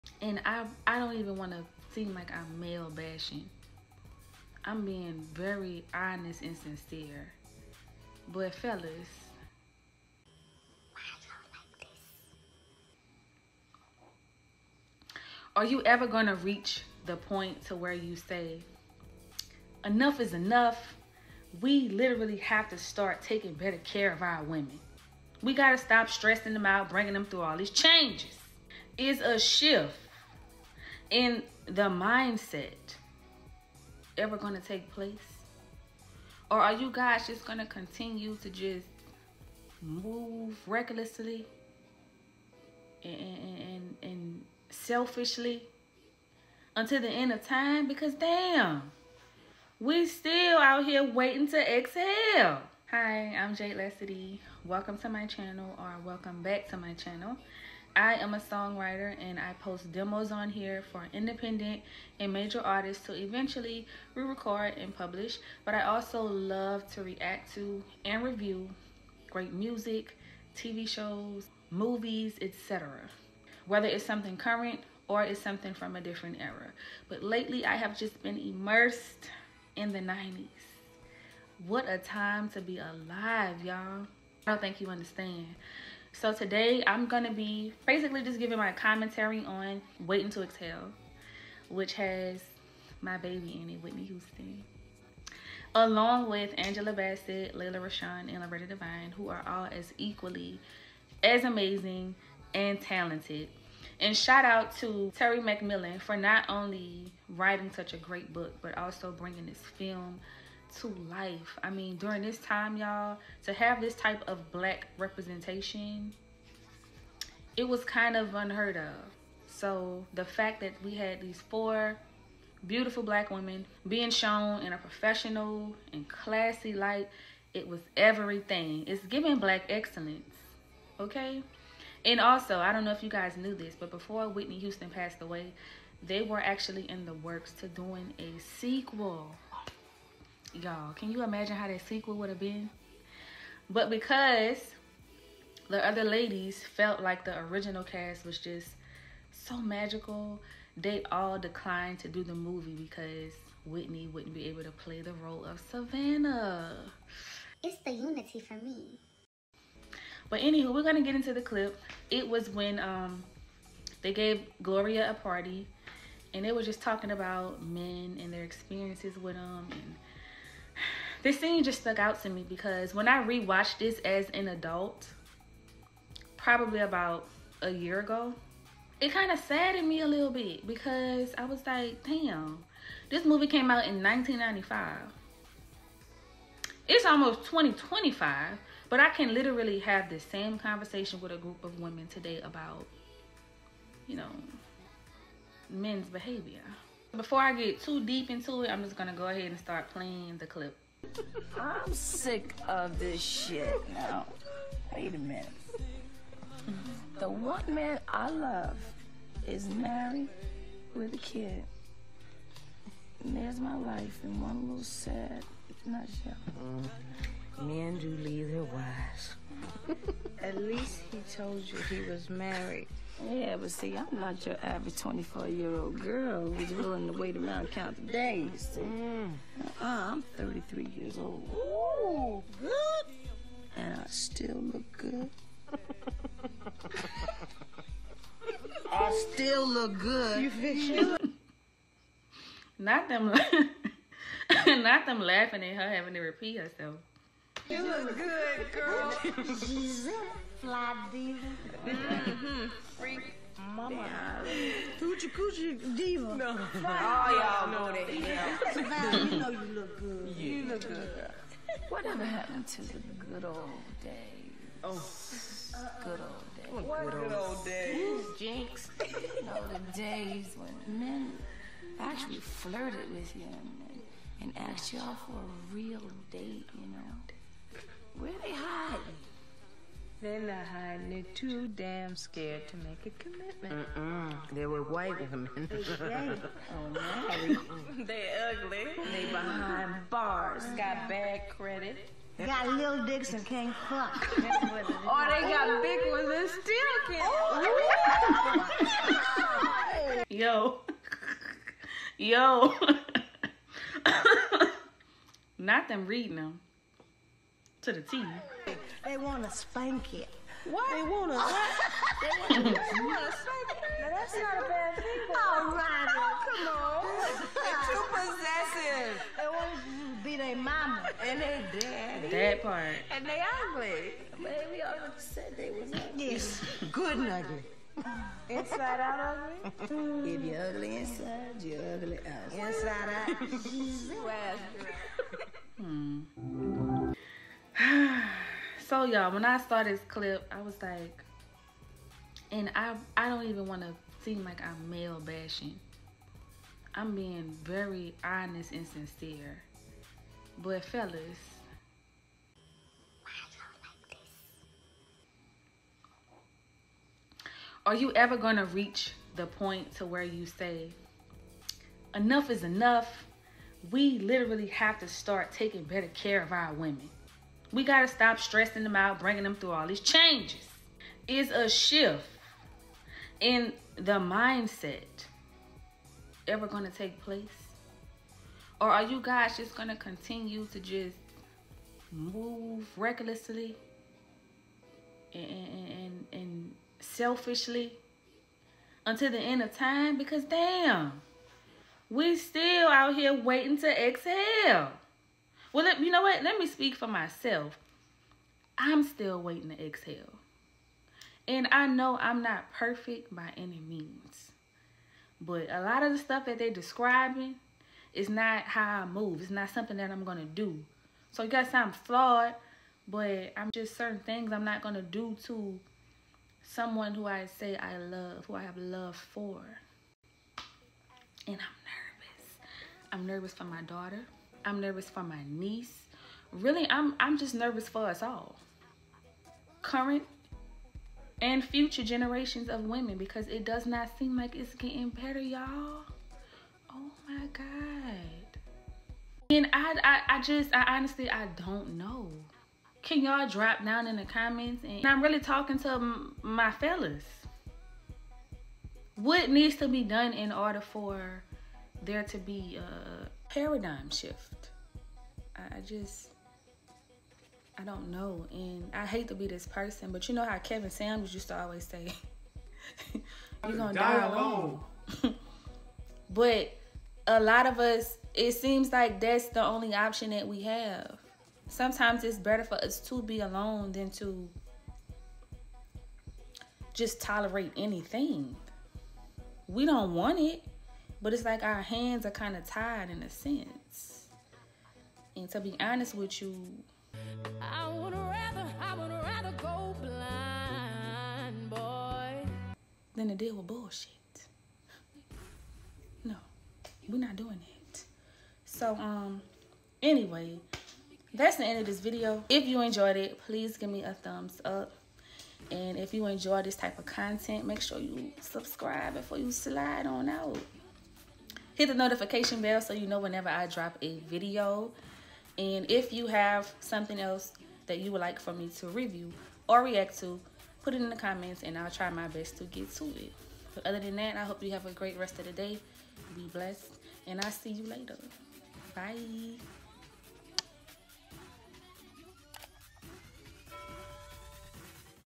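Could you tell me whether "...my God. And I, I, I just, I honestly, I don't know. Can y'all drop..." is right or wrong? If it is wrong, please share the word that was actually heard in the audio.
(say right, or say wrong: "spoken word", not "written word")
right.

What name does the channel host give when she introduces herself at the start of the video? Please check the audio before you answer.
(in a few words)
Jade Lesidi.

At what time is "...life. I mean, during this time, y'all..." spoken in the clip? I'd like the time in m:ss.
1:51.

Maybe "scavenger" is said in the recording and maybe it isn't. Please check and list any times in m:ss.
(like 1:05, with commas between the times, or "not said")
not said.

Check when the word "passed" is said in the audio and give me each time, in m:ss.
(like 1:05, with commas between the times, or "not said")
2:14.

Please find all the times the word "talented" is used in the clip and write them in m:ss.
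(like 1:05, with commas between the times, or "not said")
1:42.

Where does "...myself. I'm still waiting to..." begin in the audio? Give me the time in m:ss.
6:37.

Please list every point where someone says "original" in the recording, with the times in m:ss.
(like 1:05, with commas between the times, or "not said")
2:27.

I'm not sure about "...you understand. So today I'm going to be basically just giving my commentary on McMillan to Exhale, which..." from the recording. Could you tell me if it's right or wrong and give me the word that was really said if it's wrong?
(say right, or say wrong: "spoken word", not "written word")
wrong: "Waiting", not "McMillan".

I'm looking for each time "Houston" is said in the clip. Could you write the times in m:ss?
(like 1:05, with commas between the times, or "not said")
1:34, 2:14.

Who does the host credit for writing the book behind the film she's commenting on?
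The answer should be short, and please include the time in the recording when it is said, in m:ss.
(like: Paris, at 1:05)
Terry McMillan, at 1:45.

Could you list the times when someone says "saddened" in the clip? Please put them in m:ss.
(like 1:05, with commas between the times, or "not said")
2:59.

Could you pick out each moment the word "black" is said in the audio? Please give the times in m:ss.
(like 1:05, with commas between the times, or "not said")
1:54, 2:03, 2:09.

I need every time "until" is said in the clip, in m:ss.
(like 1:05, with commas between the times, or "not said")
0:46, 6:29.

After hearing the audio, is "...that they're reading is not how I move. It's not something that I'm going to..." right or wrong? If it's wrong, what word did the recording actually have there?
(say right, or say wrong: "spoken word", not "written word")
wrong: "describing", not "reading".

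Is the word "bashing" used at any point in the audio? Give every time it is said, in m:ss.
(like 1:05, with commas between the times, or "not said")
0:02, 5:45.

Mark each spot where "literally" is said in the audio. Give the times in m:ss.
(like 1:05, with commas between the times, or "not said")
0:21, 3:09, 6:04.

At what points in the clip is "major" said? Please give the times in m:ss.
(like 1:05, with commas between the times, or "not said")
1:02.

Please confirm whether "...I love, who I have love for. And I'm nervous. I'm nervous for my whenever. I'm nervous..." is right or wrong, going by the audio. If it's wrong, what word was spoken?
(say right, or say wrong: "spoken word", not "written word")
wrong: "daughter", not "whenever".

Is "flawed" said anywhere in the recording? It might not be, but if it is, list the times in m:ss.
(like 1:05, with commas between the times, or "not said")
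6:51.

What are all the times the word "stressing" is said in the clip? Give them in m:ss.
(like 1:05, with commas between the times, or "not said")
0:26, 6:08.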